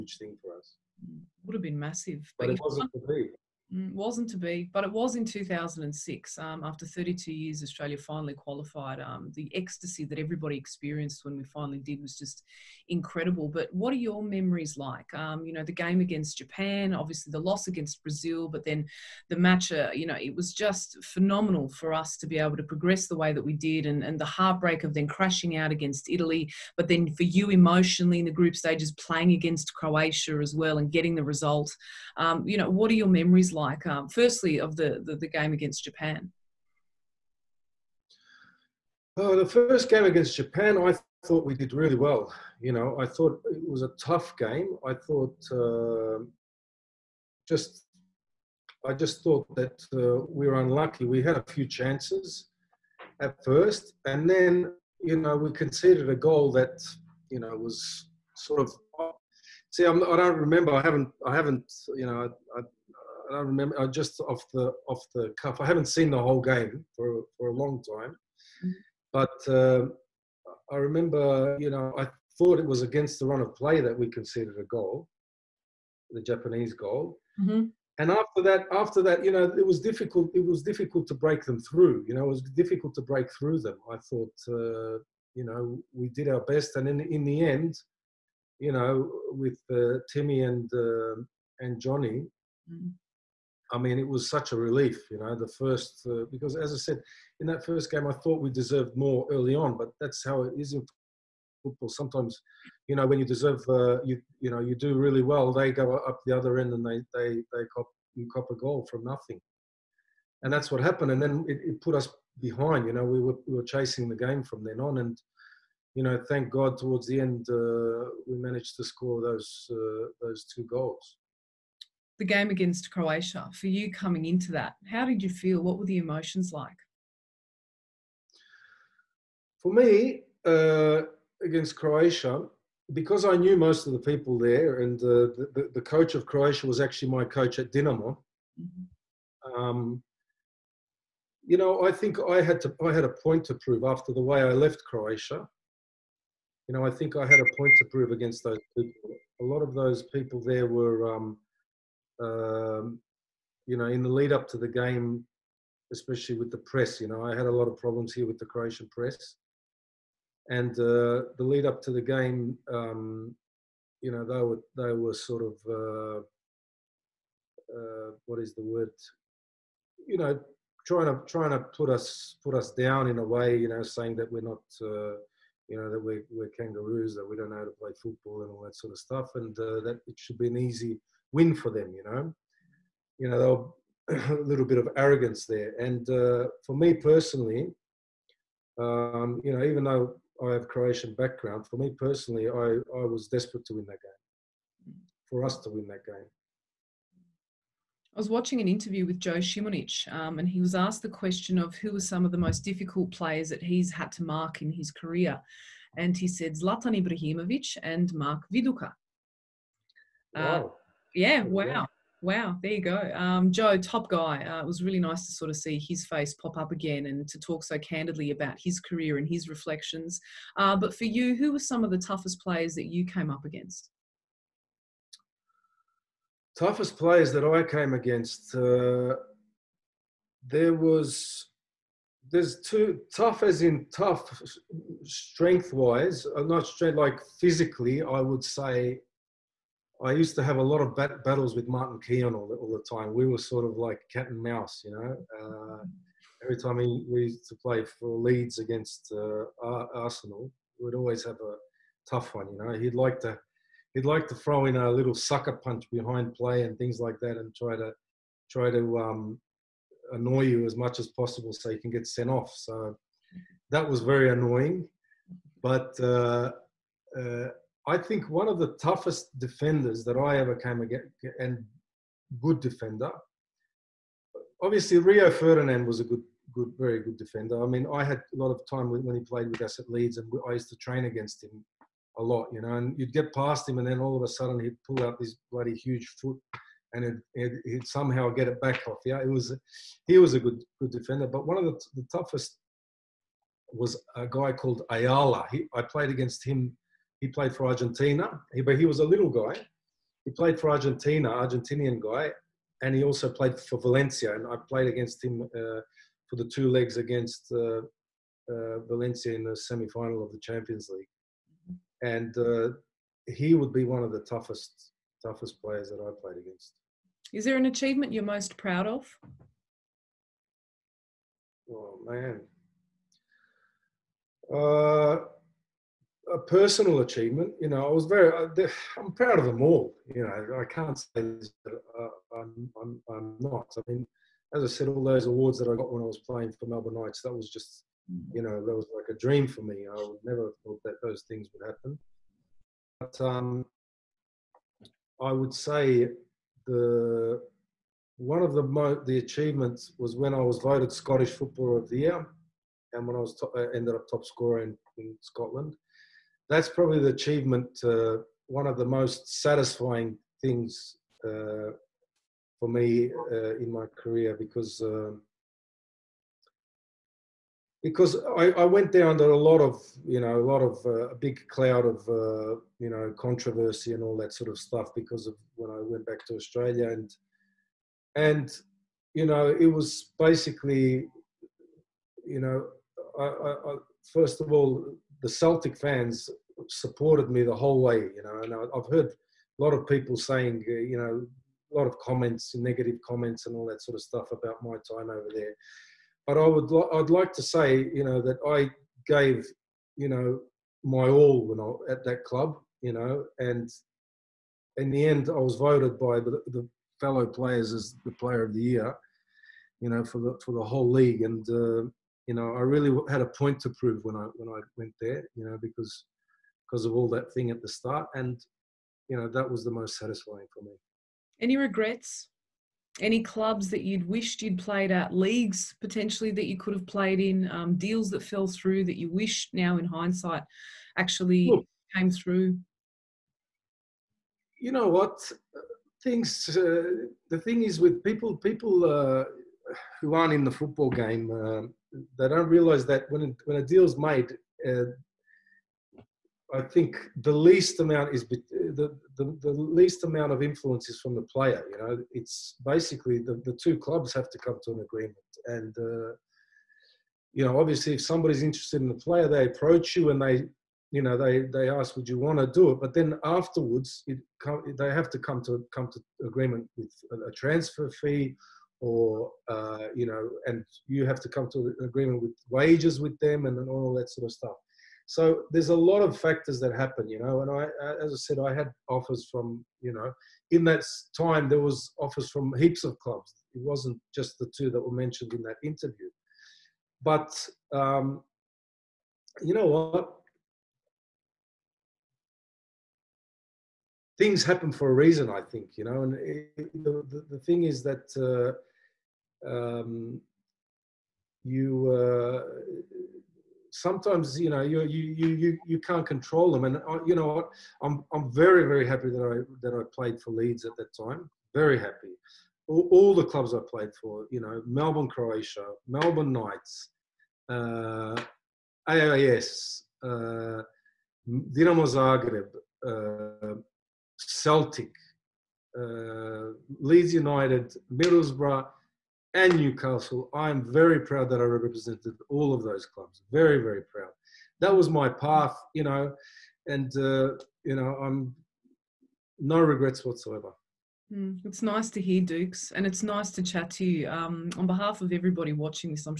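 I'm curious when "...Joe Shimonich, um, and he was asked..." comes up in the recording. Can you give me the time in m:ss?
3:19.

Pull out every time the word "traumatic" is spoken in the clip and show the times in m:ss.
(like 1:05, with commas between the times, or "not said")
not said.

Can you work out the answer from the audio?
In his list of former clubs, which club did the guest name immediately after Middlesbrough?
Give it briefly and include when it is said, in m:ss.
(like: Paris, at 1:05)
Newcastle, at 8:49.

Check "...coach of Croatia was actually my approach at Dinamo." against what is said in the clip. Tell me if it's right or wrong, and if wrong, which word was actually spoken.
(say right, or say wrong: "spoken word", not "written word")
wrong: "coach", not "approach".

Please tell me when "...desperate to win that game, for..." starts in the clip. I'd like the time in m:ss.
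3:13.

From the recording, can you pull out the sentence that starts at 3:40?
Uh, but for you, who were some of the toughest players that you came up against?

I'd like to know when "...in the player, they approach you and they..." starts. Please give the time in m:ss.
7:38.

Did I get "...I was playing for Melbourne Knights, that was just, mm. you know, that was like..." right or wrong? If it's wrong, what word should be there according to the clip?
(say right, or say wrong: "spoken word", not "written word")
right.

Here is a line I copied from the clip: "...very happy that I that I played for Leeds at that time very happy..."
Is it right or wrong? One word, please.
right.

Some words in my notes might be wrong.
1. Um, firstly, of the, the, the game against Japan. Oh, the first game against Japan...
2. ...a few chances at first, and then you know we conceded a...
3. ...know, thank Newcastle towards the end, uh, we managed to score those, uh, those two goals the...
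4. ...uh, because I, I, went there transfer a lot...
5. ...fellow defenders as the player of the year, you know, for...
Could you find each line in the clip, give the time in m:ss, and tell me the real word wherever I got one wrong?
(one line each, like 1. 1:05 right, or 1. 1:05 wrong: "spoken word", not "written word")
1. 0:33 right
2. 0:51 right
3. 1:56 wrong: "God", not "Newcastle"
4. 6:04 wrong: "under", not "transfer"
5. 6:46 wrong: "players", not "defenders".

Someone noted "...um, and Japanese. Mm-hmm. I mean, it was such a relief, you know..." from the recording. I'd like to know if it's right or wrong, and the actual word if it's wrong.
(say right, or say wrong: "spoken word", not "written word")
wrong: "Johnny", not "Japanese".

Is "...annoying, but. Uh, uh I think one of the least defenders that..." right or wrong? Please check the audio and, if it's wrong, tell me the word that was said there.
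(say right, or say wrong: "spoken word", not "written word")
wrong: "toughest", not "least".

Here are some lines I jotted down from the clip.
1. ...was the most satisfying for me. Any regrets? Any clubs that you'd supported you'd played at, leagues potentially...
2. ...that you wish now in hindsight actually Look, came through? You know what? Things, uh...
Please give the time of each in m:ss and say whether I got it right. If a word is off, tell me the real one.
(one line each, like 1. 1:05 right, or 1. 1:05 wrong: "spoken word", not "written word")
1. 6:59 wrong: "wished", not "supported"
2. 7:08 right.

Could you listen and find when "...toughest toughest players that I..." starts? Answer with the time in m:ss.
5:14.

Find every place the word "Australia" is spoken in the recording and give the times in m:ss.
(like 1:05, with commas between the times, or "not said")
0:07, 6:16.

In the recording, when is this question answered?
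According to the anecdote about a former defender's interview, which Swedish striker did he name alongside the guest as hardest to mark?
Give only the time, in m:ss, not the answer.
3:26.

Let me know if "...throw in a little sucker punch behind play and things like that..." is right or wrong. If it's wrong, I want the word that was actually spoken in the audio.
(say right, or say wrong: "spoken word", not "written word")
right.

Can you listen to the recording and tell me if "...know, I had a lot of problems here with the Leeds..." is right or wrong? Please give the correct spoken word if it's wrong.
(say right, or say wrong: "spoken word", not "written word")
wrong: "Croatian", not "Leeds".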